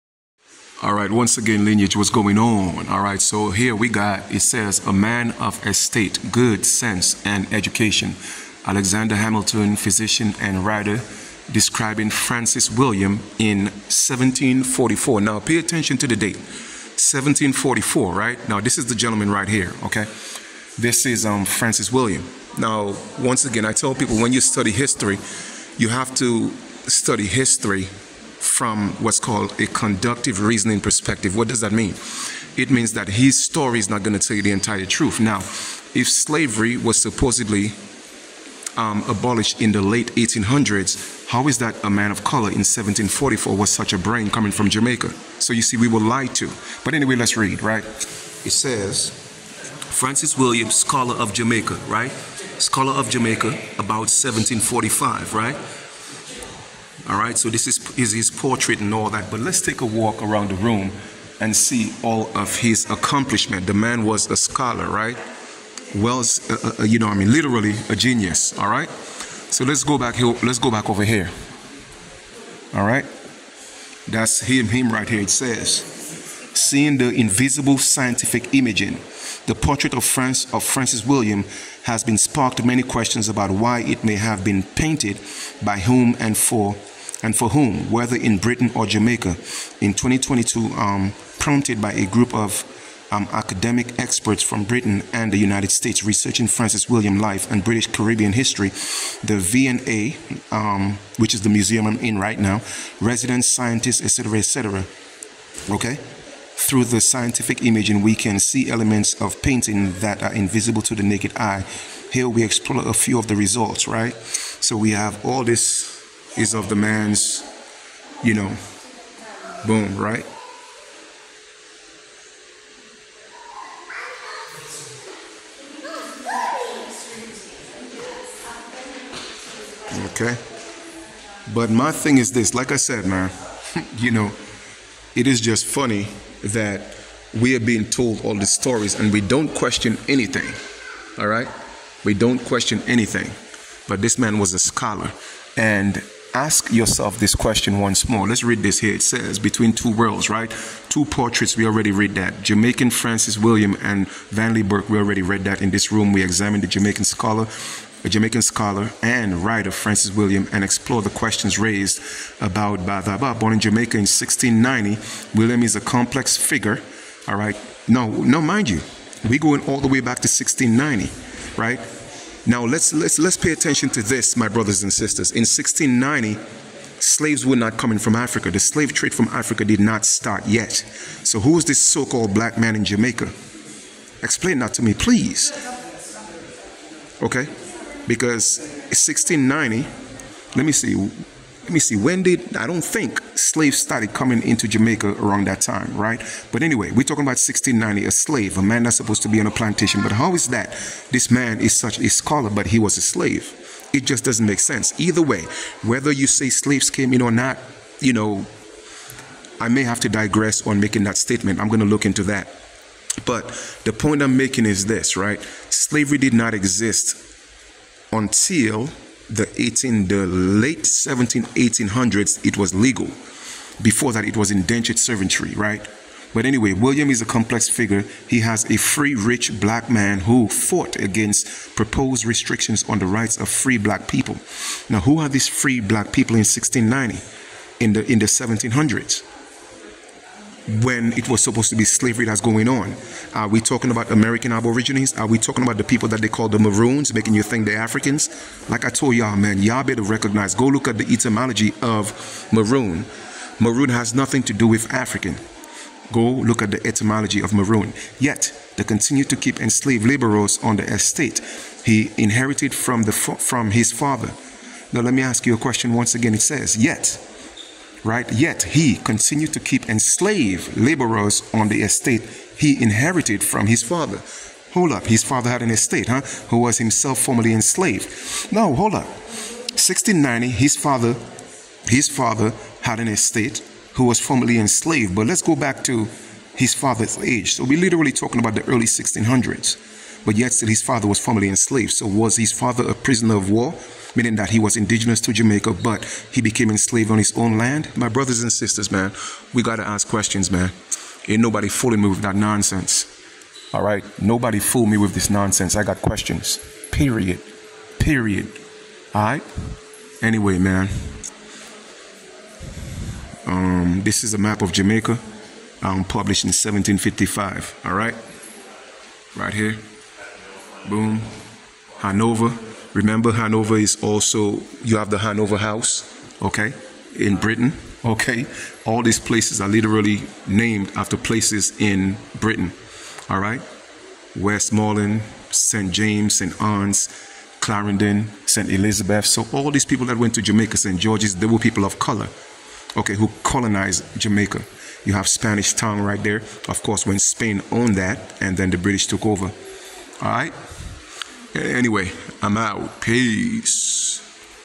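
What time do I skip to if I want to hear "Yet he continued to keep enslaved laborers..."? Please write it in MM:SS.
04:28.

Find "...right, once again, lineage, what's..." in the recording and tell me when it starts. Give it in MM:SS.
00:00.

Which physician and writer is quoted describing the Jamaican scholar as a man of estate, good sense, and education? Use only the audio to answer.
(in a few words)
Alexander Hamilton.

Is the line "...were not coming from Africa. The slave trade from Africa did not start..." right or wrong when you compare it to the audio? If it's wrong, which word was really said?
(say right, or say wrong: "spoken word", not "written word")
right.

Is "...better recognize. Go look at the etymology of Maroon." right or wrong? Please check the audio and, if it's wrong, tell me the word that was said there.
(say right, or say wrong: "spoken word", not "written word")
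right.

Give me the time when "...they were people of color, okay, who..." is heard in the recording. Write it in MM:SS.
05:41.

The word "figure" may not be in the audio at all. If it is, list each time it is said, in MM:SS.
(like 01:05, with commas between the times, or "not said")
02:46, 03:47.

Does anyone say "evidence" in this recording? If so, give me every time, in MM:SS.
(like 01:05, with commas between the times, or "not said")
not said.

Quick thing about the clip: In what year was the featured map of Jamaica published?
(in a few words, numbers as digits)
1755.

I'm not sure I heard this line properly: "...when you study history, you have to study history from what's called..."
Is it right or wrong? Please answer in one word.
right.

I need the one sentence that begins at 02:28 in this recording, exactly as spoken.
It says, Between two worlds, right?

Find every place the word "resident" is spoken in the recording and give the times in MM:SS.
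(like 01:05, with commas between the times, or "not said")
01:43.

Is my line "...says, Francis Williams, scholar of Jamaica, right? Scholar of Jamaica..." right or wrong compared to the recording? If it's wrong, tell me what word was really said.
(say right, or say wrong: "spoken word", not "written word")
right.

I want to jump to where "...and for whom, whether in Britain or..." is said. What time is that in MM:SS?
01:27.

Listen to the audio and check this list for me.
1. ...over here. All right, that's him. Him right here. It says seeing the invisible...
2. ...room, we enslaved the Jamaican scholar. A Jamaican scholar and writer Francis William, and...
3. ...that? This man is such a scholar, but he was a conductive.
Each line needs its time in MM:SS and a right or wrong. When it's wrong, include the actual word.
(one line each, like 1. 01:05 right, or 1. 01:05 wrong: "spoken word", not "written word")
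1. 01:10 right
2. 02:35 wrong: "examined", not "enslaved"
3. 03:20 wrong: "slave", not "conductive".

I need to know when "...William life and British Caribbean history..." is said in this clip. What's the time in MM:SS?
01:36.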